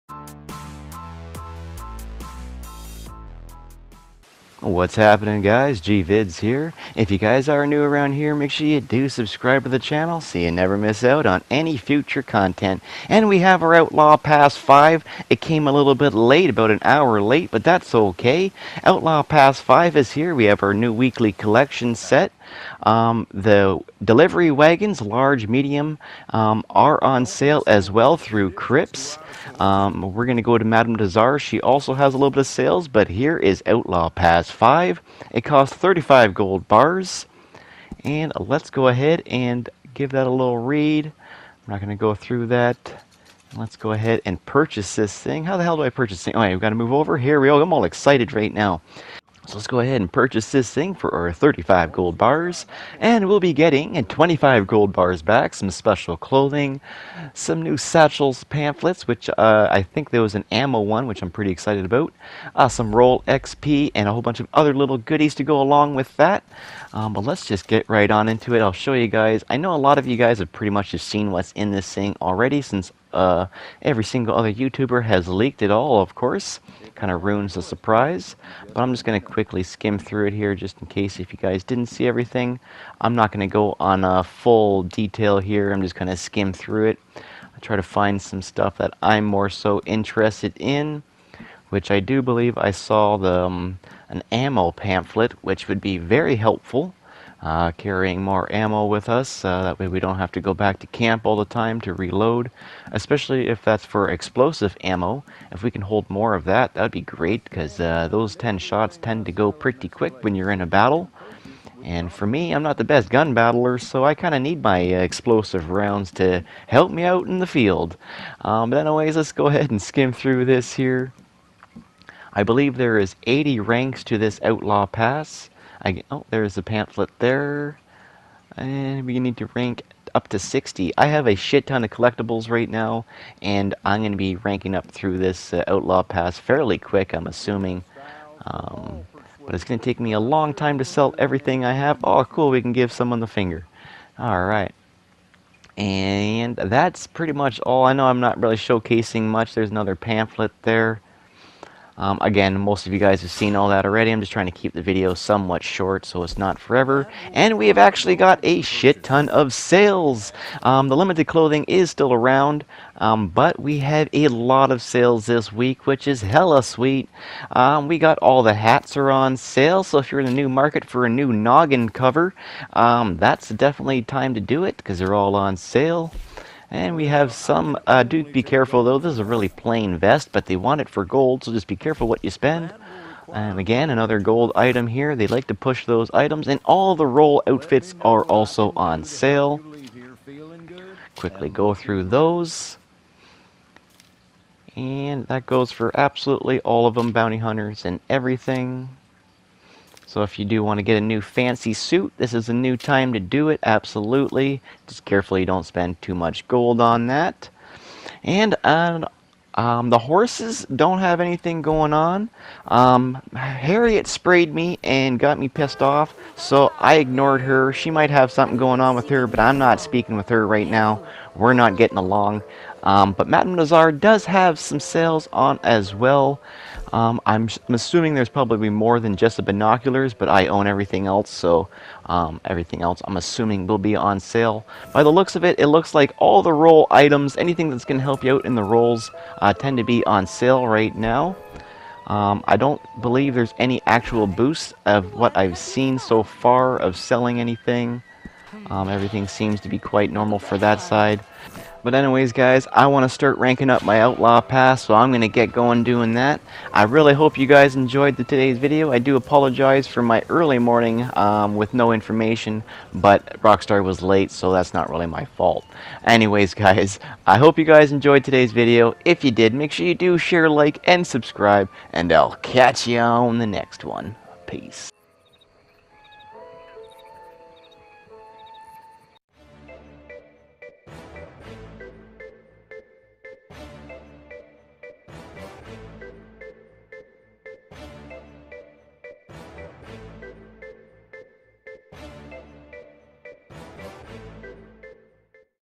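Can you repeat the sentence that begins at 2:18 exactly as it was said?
Um, but it's going to take me a long time to sell everything I have.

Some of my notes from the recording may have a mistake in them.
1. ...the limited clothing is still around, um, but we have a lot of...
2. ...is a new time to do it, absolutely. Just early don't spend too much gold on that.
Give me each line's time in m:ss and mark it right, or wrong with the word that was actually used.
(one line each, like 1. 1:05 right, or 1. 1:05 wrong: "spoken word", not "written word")
1. 2:40 right
2. 3:22 wrong: "carefully", not "early".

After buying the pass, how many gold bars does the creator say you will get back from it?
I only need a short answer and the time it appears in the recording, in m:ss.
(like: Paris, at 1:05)
25 gold bars, at 0:54.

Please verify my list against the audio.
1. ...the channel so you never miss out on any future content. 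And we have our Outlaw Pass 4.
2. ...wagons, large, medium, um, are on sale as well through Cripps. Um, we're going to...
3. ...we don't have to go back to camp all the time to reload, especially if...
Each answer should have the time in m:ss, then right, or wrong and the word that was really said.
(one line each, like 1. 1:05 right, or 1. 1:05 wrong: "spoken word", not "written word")
1. 0:09 wrong: "5", not "4"
2. 0:24 right
3. 1:39 right.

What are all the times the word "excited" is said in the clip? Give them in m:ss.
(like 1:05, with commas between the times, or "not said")
0:47, 1:01.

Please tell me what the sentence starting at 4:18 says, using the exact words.
I do apologize for my early morning um, with no information, but Rockstar was late, so that's not really my fault.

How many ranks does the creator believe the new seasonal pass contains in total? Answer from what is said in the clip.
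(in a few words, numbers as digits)
80.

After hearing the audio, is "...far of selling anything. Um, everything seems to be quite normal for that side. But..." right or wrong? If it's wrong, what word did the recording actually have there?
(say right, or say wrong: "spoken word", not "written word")
right.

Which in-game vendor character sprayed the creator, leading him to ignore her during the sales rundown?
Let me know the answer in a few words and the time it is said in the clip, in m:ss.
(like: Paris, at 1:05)
Harriet, at 3:33.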